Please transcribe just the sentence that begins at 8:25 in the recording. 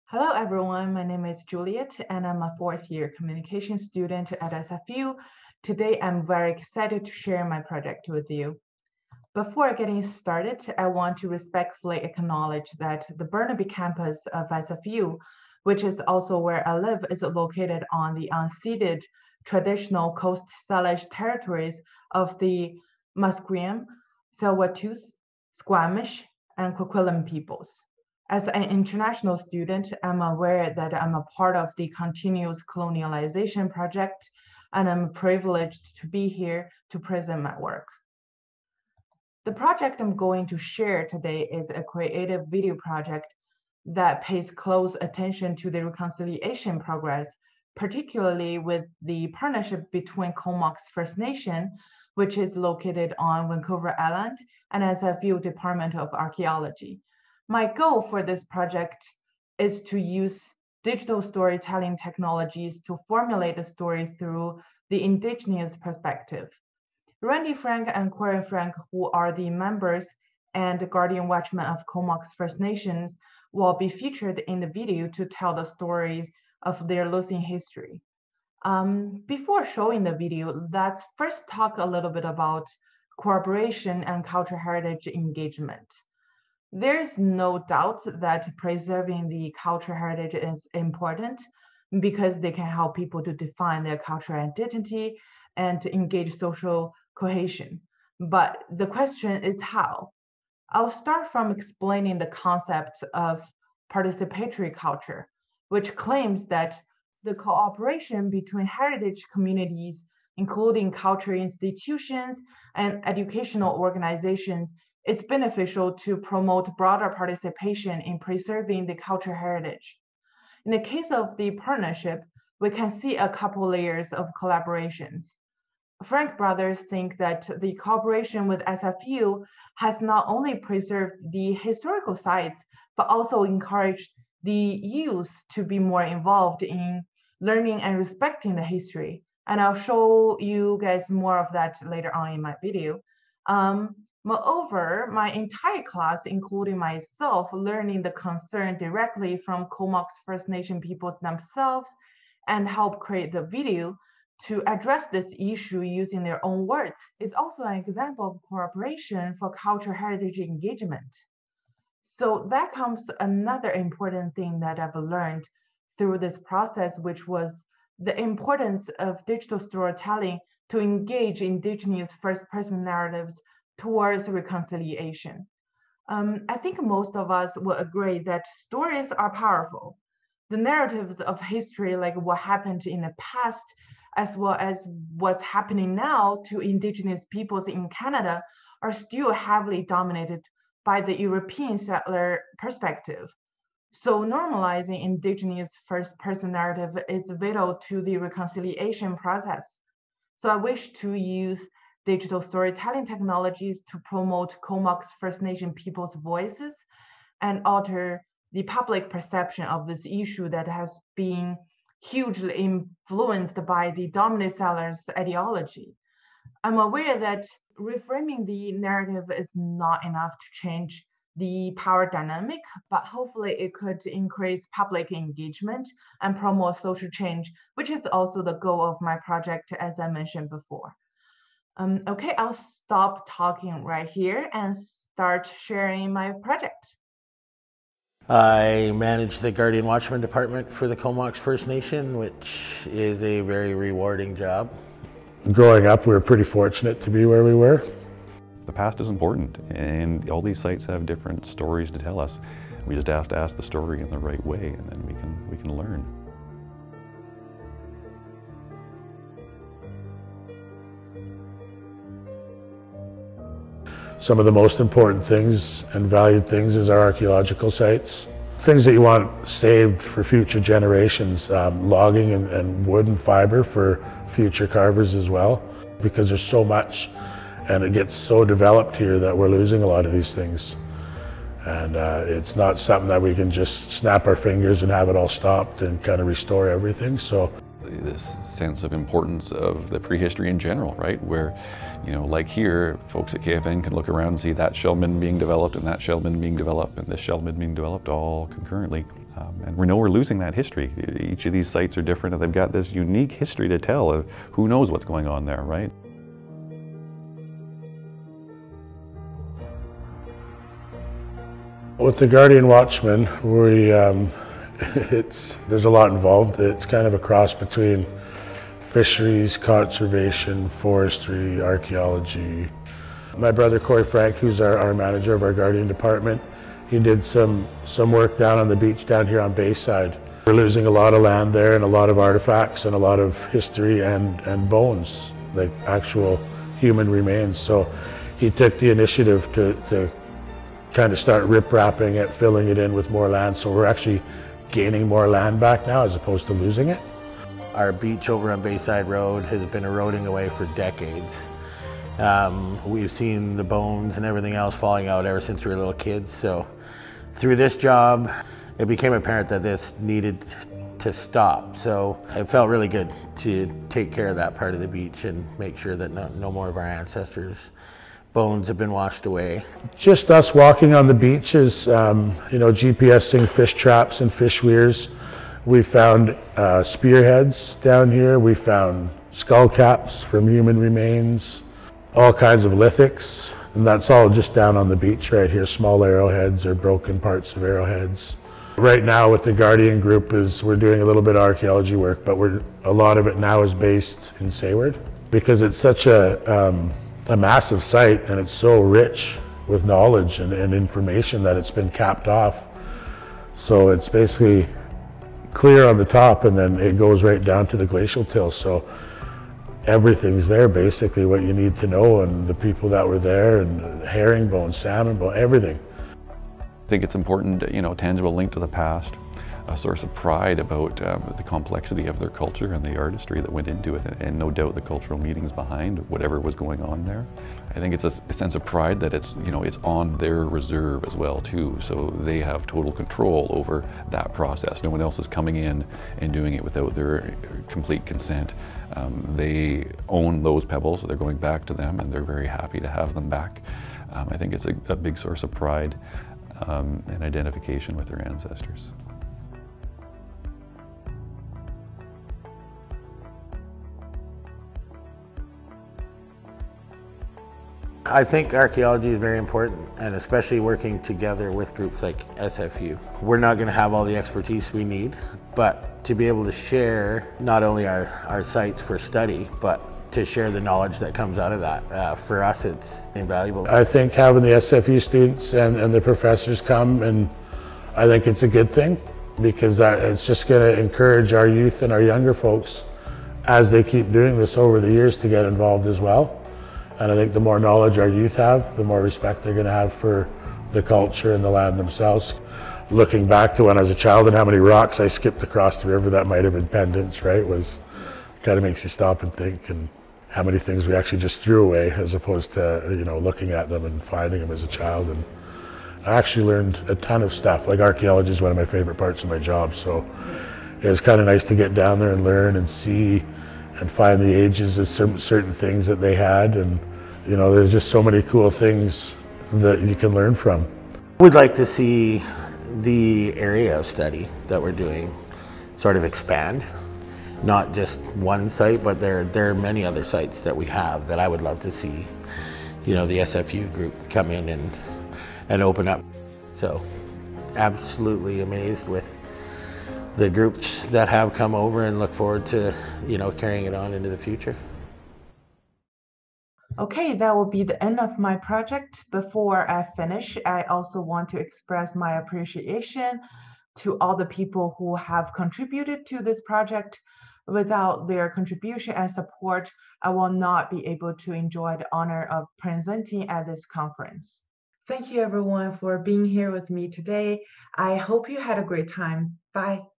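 And I actually learned a ton of stuff.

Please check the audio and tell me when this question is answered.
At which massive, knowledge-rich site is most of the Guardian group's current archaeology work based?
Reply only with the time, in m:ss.
6:34.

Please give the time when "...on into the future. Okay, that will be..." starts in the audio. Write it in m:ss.
9:03.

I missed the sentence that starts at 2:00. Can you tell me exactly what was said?
In the case of the partnership, we can see a couple layers of collaborations.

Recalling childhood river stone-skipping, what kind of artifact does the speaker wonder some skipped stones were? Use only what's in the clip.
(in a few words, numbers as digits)
pendants.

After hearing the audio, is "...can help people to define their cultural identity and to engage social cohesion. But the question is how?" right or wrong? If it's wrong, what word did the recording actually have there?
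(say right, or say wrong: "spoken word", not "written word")
right.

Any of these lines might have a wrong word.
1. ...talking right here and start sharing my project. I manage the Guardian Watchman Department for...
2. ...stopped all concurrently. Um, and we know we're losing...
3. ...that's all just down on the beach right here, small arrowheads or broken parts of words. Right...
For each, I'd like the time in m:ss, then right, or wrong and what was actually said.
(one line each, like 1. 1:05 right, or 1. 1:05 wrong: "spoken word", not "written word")
1. 3:53 right
2. 4:57 wrong: "developed", not "stopped"
3. 6:23 wrong: "arrowheads", not "words".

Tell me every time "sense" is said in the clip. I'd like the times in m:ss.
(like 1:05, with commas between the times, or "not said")
4:48, 7:08.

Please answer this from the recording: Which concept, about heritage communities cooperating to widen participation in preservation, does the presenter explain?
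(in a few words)
participatory culture.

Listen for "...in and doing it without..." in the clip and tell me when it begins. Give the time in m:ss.
7:15.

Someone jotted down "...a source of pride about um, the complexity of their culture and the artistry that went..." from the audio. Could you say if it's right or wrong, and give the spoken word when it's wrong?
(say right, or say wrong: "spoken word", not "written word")
right.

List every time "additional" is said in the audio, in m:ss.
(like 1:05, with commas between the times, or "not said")
not said.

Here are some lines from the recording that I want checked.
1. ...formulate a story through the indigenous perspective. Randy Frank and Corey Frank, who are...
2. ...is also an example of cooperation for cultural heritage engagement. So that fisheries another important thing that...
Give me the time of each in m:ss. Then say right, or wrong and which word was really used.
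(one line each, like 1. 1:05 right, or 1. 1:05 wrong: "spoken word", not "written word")
1. 1:03 right
2. 2:37 wrong: "comes", not "fisheries".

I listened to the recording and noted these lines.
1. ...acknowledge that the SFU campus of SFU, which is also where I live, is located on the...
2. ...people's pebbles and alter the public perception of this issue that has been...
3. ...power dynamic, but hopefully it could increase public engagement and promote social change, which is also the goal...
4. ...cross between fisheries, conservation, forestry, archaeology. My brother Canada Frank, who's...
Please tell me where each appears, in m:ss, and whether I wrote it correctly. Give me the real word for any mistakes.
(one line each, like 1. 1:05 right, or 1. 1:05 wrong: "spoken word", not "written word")
1. 0:11 wrong: "Burnaby", not "SFU"
2. 3:25 wrong: "voices", not "pebbles"
3. 3:41 right
4. 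5:17 wrong: "Corey", not "Canada".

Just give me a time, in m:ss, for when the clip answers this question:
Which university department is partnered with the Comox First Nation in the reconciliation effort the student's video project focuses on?
0:55.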